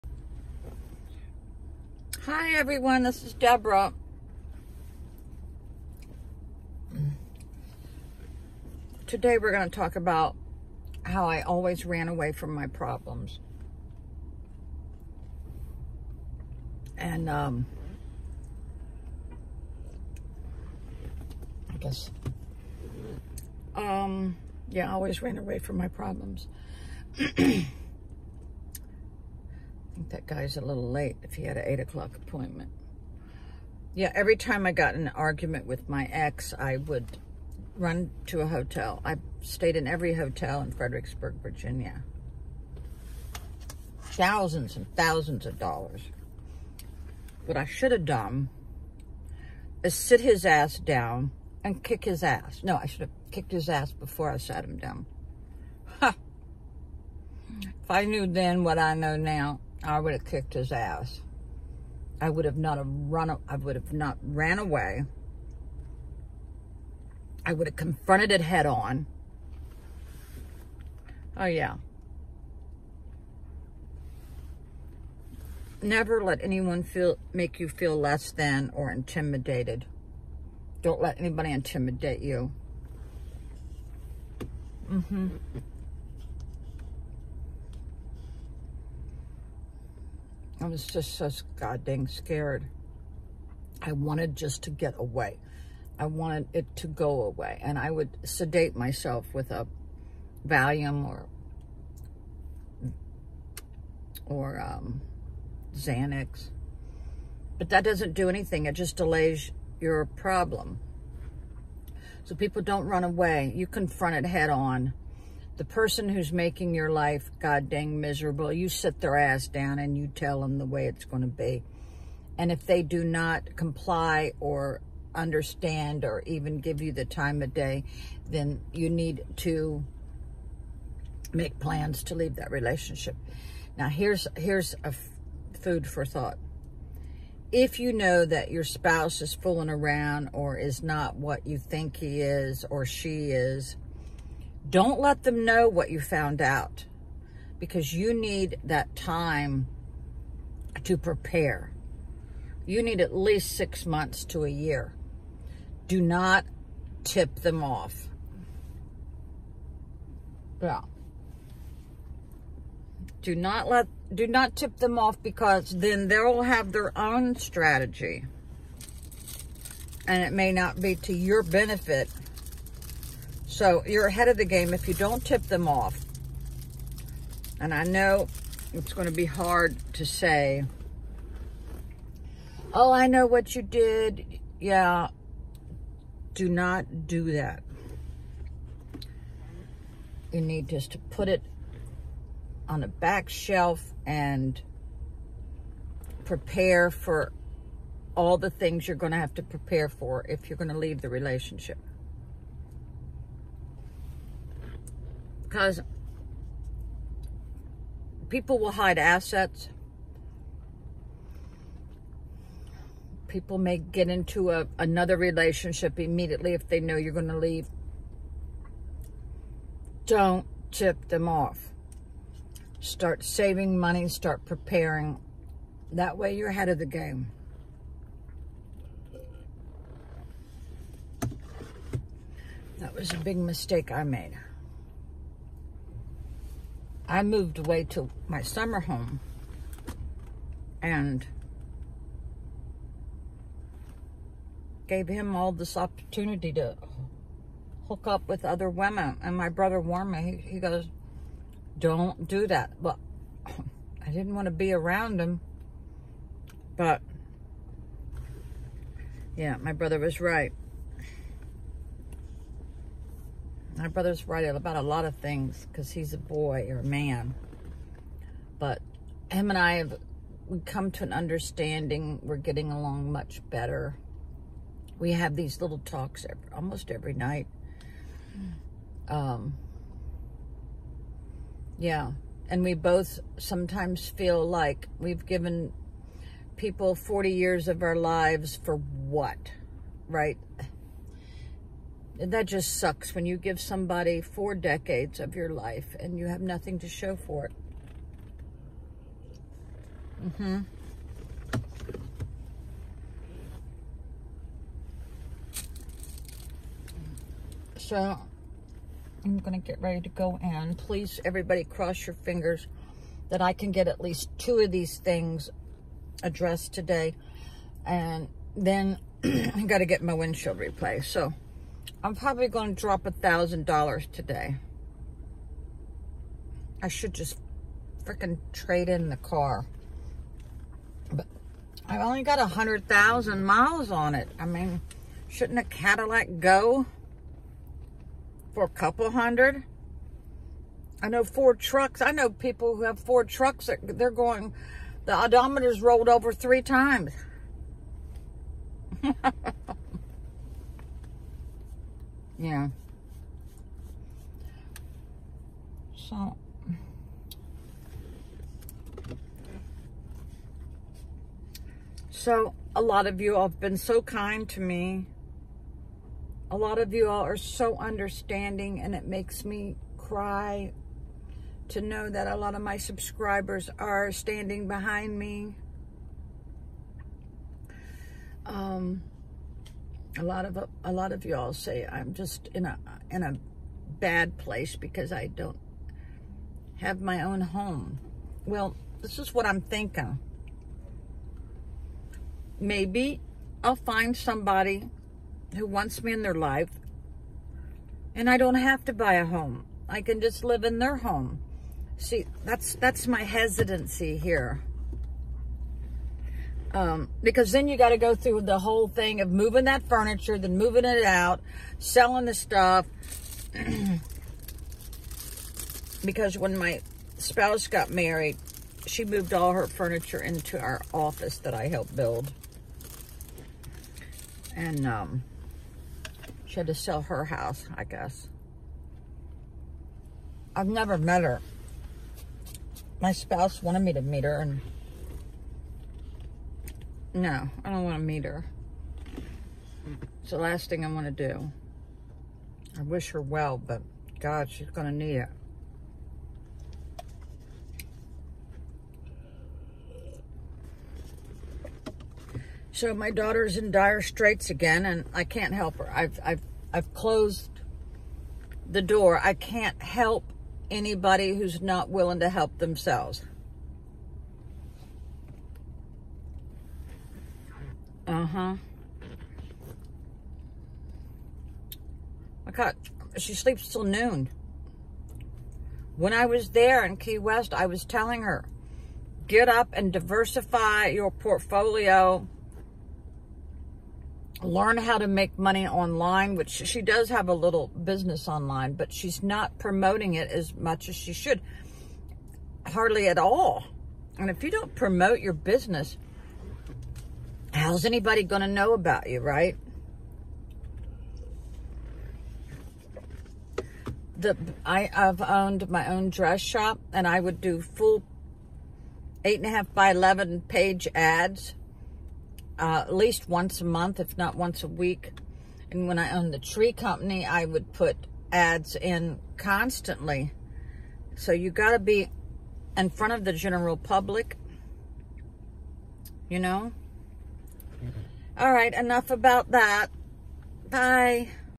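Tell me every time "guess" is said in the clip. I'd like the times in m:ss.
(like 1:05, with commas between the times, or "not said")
0:21, 7:07.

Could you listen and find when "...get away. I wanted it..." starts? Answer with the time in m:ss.
1:34.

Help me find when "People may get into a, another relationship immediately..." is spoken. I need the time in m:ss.
3:33.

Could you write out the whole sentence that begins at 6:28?
Well, this is what I'm thinking.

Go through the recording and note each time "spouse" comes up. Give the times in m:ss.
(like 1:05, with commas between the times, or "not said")
2:18, 6:57, 7:13.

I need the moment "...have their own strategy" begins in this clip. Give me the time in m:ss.
2:46.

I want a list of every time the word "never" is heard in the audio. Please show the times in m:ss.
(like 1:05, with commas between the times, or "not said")
1:15, 7:10.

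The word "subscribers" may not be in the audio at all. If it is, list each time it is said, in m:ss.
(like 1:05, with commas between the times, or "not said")
6:12.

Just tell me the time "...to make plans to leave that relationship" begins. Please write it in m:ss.
2:09.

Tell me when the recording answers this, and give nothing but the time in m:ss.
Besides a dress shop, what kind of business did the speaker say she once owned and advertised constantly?
8:36.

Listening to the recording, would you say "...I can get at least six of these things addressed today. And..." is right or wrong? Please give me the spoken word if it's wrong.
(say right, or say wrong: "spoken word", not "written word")
wrong: "two", not "six".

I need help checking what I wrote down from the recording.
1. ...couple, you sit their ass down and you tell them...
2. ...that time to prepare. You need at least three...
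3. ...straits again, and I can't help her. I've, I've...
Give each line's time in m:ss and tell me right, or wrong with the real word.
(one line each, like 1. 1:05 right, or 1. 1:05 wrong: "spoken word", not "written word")
1. 1:58 wrong: "miserable", not "couple"
2. 2:28 wrong: "six", not "three"
3. 7:34 right.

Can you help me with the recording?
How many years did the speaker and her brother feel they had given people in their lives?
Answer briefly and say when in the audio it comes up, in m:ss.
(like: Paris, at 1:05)
40, at 4:46.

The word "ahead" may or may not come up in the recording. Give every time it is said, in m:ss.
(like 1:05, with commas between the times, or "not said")
2:54, 3:46.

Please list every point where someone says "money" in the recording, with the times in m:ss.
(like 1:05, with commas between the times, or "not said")
3:43, 8:05.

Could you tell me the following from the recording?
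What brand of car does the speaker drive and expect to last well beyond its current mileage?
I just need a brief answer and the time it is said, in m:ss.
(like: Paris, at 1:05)
Cadillac, at 5:35.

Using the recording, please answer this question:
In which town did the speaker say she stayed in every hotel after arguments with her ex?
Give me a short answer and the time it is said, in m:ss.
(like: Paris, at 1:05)
Fredericksburg, Virginia, at 0:40.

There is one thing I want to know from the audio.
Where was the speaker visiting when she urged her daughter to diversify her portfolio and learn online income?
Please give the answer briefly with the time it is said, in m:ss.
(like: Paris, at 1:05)
Key West, at 7:56.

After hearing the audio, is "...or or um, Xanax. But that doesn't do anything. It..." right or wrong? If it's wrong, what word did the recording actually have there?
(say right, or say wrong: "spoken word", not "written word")
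right.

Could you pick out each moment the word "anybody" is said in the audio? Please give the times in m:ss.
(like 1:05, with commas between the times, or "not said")
1:21, 7:40, 8:17.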